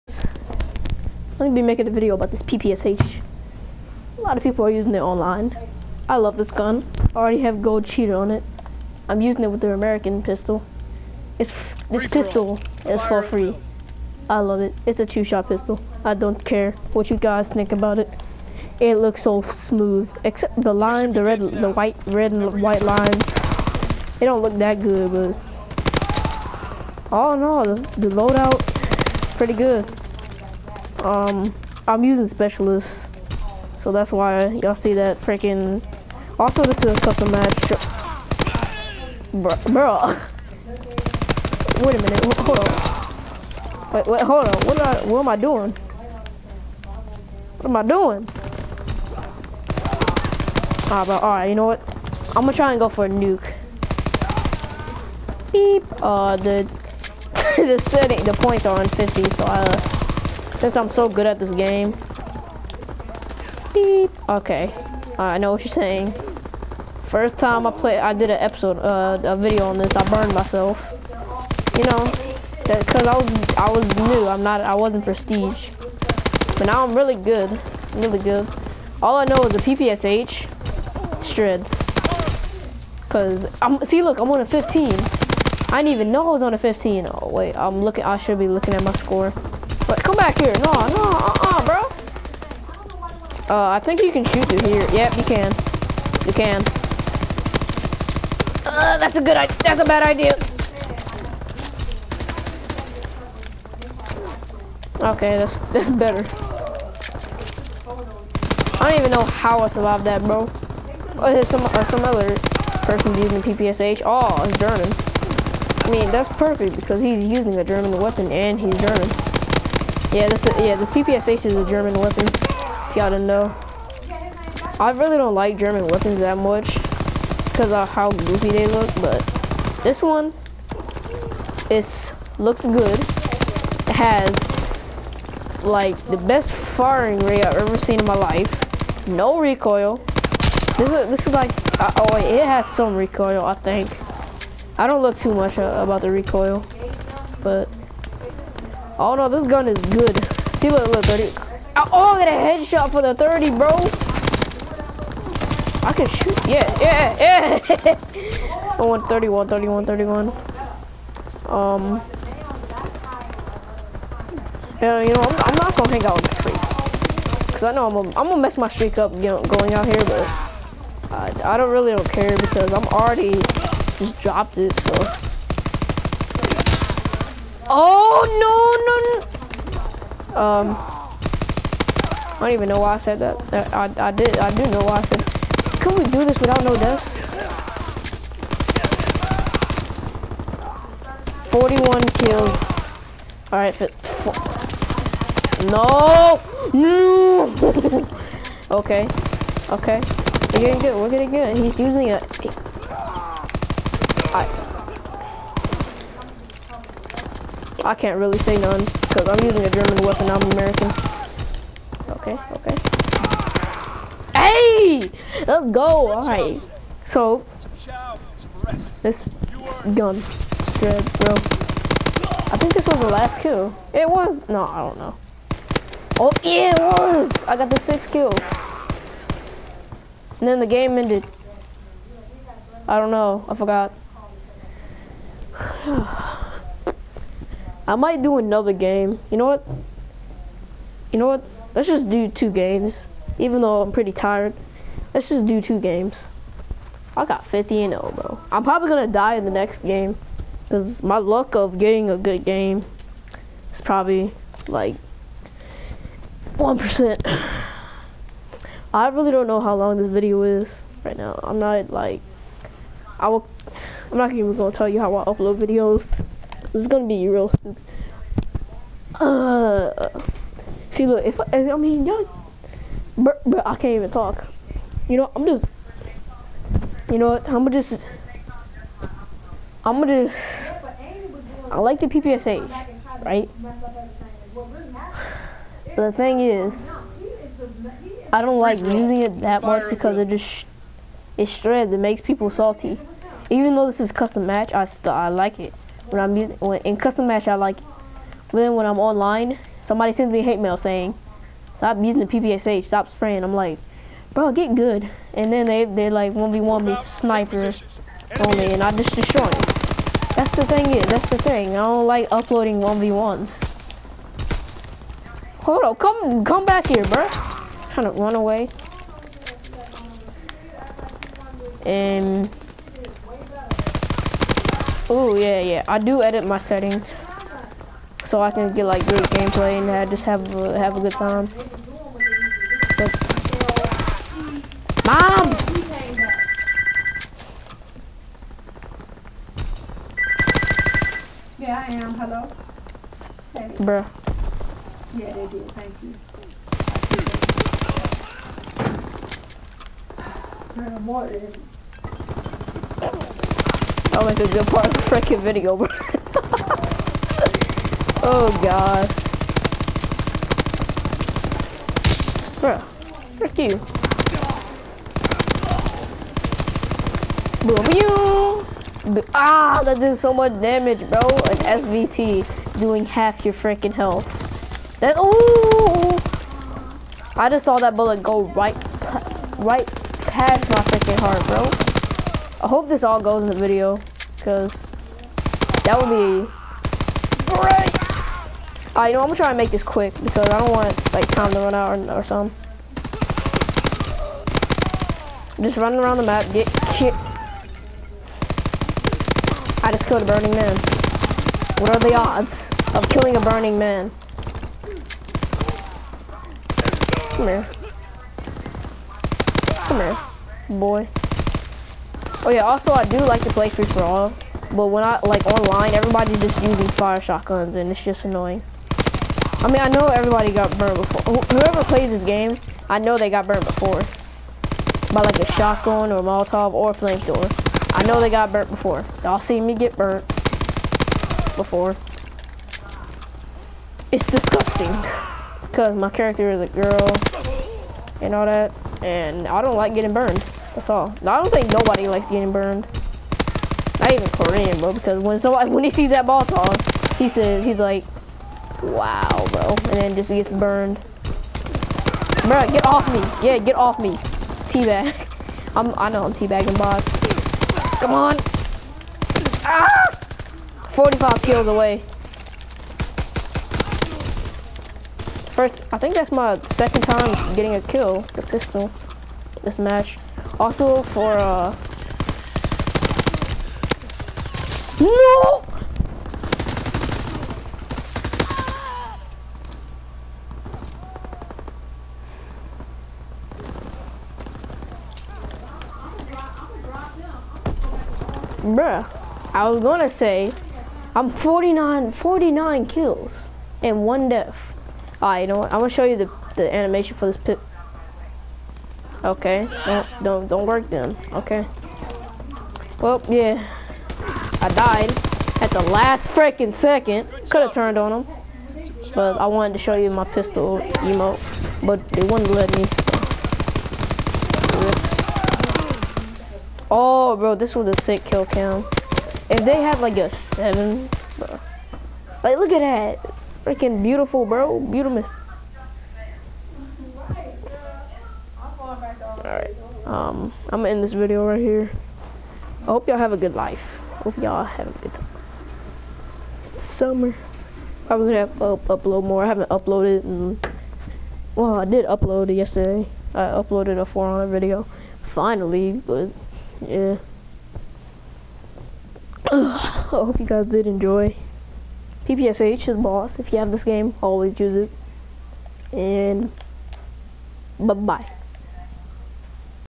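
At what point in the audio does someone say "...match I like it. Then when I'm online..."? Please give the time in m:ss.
4:57.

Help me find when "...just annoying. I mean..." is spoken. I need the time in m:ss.
6:58.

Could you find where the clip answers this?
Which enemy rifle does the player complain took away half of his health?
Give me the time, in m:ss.
6:11.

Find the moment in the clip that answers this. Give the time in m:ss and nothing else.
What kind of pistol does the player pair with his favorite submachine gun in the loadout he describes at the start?
0:09.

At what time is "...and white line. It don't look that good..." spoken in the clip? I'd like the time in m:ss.
0:22.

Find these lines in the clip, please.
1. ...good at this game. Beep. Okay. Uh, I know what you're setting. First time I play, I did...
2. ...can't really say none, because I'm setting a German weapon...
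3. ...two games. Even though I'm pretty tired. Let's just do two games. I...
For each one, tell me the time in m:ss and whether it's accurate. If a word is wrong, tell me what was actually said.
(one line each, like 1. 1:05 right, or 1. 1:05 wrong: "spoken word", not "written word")
1. 1:01 wrong: "saying", not "setting"
2. 3:27 wrong: "using", not "setting"
3. 4:02 right.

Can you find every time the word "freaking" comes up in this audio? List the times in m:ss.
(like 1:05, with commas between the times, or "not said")
0:35, 5:55, 6:13, 6:20, 8:26, 8:43.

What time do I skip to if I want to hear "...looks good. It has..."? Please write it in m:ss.
2:12.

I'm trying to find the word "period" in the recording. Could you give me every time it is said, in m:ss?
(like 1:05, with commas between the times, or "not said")
not said.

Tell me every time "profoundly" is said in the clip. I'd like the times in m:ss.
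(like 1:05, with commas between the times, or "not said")
not said.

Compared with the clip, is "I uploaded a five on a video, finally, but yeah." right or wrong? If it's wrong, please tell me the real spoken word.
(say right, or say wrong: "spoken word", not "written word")
wrong: "four", not "five".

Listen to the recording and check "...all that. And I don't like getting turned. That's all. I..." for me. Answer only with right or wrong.
wrong.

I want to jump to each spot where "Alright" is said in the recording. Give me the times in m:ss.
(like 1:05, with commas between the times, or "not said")
3:13, 3:36, 8:15, 8:49.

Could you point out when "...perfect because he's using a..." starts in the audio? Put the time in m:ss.
1:56.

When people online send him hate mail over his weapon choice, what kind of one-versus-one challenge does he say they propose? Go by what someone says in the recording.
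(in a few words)
Sniper only.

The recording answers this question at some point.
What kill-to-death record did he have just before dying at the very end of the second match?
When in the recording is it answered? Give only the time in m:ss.
8:12.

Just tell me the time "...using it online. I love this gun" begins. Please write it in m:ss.
0:04.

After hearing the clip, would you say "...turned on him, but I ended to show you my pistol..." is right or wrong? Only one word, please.
wrong.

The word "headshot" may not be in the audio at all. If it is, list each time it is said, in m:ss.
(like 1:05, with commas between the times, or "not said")
2:32.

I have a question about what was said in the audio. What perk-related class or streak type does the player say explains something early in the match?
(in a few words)
Specialist.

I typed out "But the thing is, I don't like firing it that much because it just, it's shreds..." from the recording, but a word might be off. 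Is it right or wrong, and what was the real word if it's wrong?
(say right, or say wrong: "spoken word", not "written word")
wrong: "using", not "firing".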